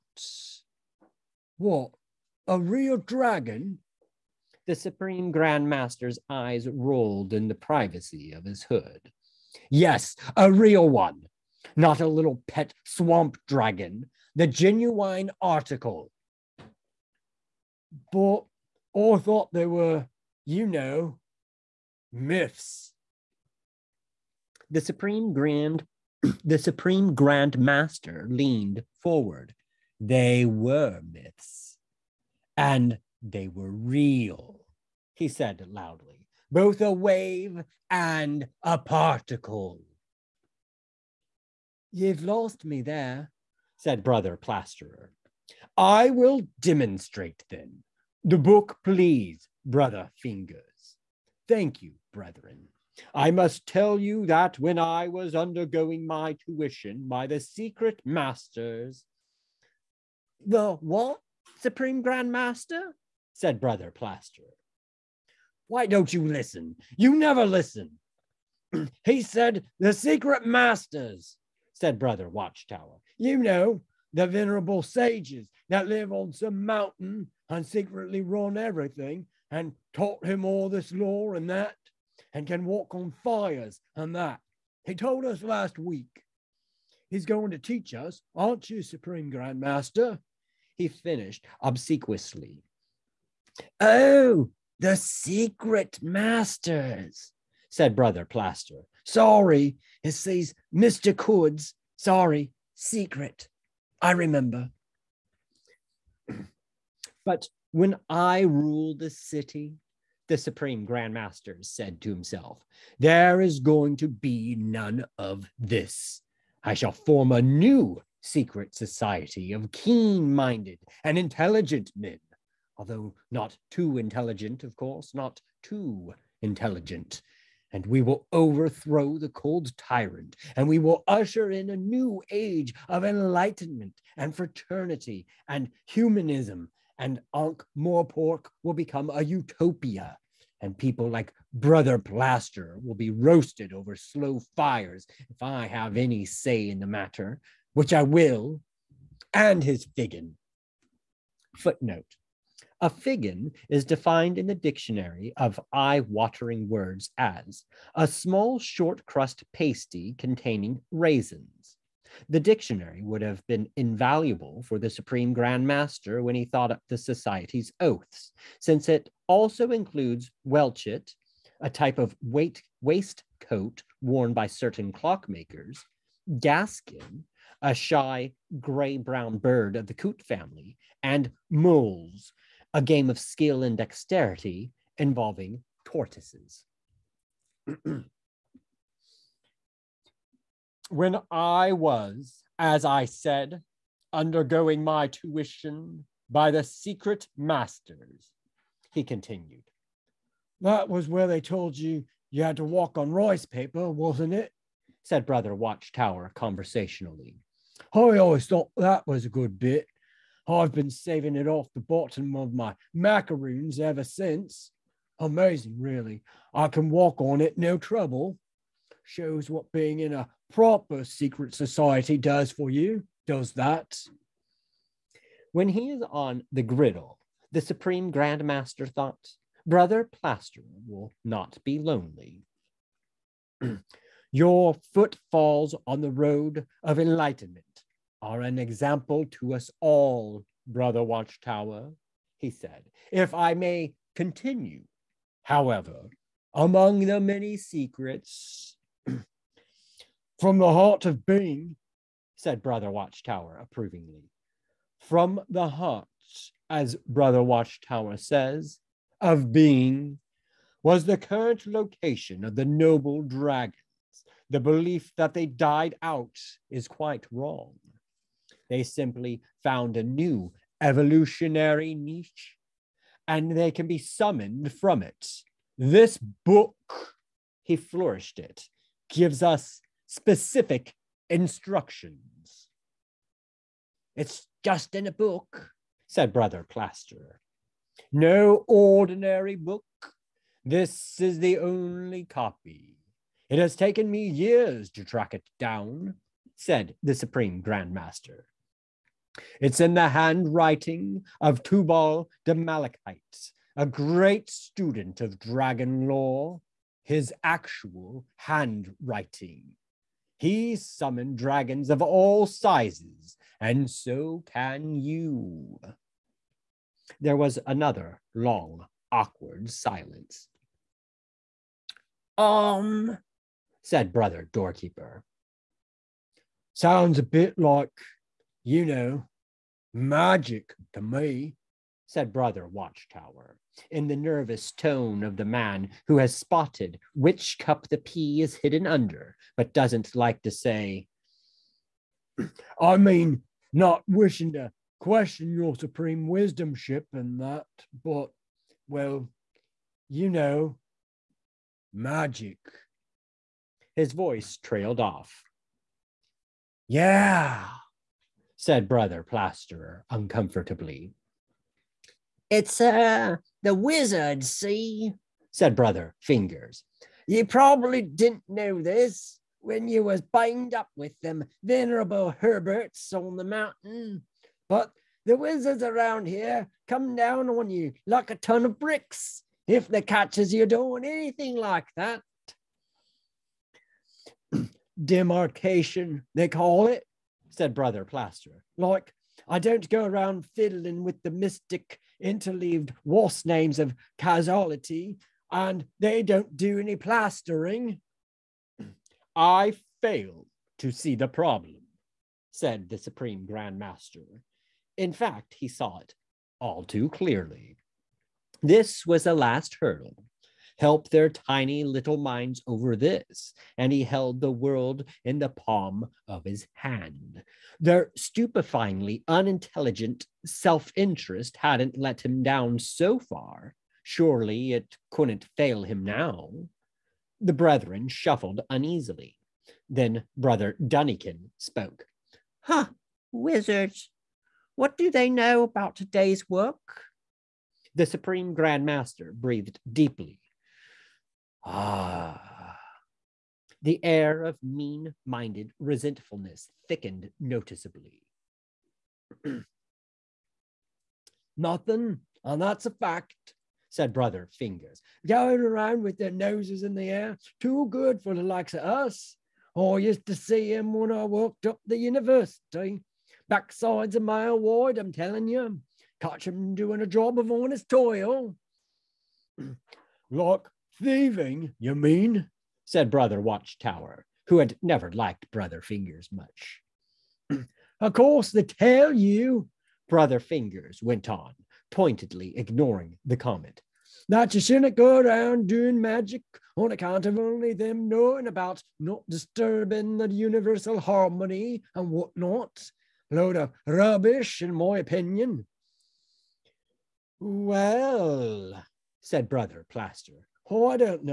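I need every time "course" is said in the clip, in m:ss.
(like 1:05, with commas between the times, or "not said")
2:04, 7:58.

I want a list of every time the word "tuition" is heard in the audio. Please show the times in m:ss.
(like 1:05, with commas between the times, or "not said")
0:56, 3:15.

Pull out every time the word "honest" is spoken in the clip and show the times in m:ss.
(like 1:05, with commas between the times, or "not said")
7:47.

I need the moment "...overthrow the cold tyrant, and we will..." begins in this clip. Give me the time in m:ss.
2:08.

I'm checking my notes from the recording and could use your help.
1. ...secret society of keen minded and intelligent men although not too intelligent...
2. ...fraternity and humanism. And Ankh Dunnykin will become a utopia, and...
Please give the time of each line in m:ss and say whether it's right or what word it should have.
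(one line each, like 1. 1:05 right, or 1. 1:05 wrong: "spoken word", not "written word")
1. 1:58 right
2. 2:14 wrong: "Morpork", not "Dunnykin".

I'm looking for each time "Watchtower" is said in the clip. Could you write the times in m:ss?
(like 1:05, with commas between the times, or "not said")
1:12, 3:25, 4:01, 4:12, 4:17, 5:32, 7:53.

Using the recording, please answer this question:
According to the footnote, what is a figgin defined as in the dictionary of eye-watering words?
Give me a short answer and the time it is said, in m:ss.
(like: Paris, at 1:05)
small short crust pasty, at 2:37.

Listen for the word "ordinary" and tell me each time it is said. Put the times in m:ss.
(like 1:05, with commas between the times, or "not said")
4:48.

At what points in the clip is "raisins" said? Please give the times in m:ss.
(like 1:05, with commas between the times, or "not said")
2:40.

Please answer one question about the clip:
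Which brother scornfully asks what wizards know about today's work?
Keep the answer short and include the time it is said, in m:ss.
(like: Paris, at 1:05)
Brother Dunnykin, at 7:10.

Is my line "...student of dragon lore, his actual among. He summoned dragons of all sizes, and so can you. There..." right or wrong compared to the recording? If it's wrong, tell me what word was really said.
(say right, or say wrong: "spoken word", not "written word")
wrong: "handwriting", not "among".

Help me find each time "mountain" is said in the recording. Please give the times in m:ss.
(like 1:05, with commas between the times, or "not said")
1:16, 6:13.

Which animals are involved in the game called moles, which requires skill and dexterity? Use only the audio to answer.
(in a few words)
tortoises.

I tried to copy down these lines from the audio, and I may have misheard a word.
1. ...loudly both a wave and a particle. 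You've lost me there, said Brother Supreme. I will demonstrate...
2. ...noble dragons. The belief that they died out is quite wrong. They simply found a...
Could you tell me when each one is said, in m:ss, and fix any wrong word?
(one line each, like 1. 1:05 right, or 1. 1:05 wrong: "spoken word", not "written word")
1. 0:35 wrong: "Plasterer", not "Supreme"
2. 4:22 right.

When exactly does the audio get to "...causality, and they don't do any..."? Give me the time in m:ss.
6:34.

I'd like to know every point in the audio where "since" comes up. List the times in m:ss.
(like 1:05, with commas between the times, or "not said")
2:48, 3:34.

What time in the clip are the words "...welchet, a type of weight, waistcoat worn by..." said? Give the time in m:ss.
2:50.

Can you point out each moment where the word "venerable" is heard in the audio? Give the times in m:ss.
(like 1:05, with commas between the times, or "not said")
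1:14, 6:11.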